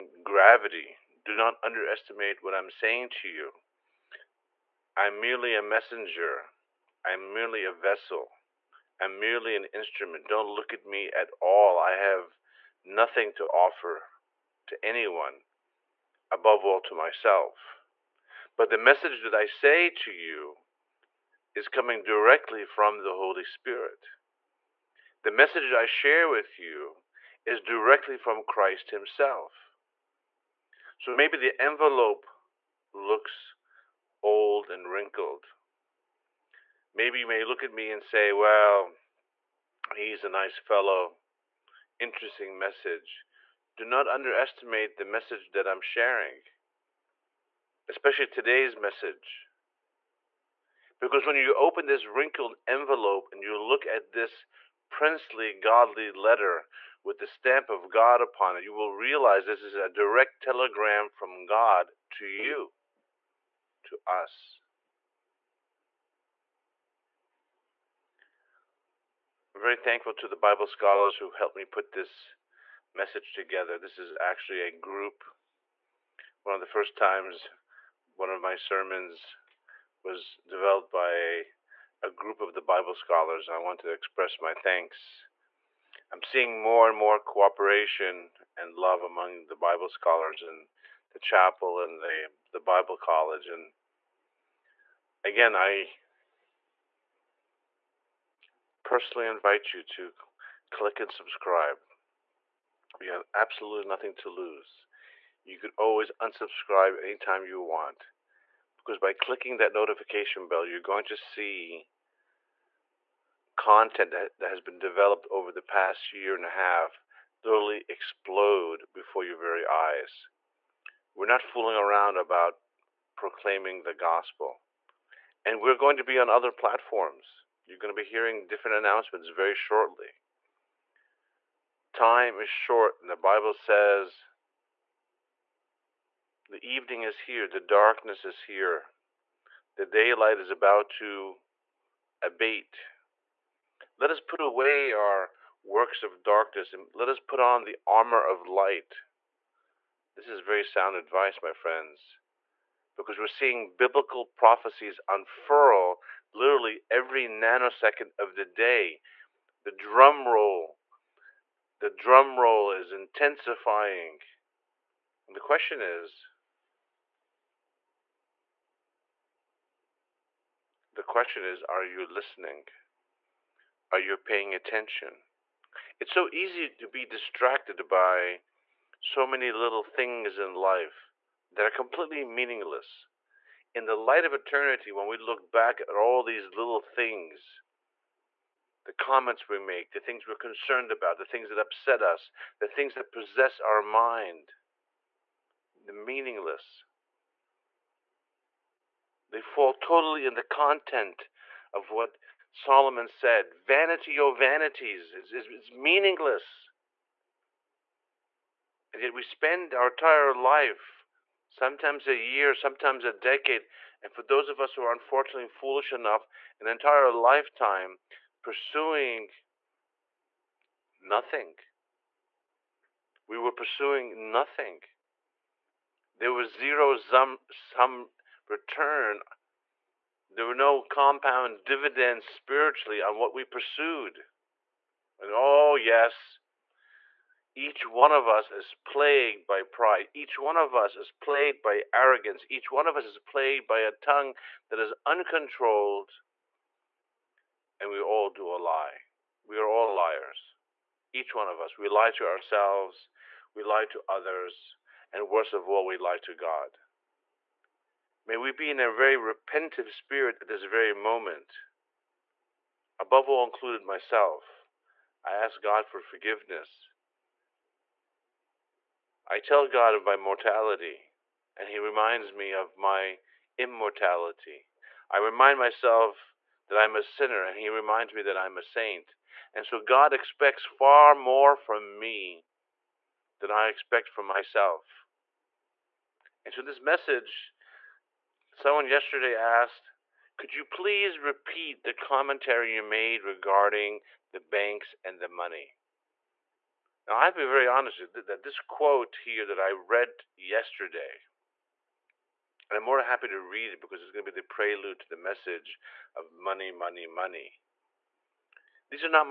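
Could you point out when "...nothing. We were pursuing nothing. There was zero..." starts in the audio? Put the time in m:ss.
3:40.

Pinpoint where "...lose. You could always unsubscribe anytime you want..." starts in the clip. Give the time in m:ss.
1:44.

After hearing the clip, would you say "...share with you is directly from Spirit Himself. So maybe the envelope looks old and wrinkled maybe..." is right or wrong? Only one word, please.
wrong.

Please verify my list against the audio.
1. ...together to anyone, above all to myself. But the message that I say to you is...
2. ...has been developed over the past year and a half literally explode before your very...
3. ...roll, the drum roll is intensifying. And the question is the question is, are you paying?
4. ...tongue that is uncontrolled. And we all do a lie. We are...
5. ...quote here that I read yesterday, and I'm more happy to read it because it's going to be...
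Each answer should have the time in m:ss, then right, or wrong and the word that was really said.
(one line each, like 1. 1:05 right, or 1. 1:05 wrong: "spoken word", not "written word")
1. 0:13 wrong: "offer", not "together"
2. 1:54 right
3. 2:40 wrong: "listening", not "paying"
4. 4:03 right
5. 4:58 right.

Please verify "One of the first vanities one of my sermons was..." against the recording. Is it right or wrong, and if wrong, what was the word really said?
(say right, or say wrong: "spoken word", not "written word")
wrong: "times", not "vanities".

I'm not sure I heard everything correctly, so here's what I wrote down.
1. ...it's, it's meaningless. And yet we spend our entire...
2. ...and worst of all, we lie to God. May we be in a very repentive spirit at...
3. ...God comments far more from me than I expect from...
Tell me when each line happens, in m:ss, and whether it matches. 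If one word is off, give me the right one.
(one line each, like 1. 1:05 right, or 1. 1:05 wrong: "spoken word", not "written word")
1. 3:25 right
2. 4:15 right
3. 4:39 wrong: "expects", not "comments".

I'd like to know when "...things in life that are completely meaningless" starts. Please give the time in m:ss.
2:59.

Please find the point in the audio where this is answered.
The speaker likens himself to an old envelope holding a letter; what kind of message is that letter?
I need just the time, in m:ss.
0:59.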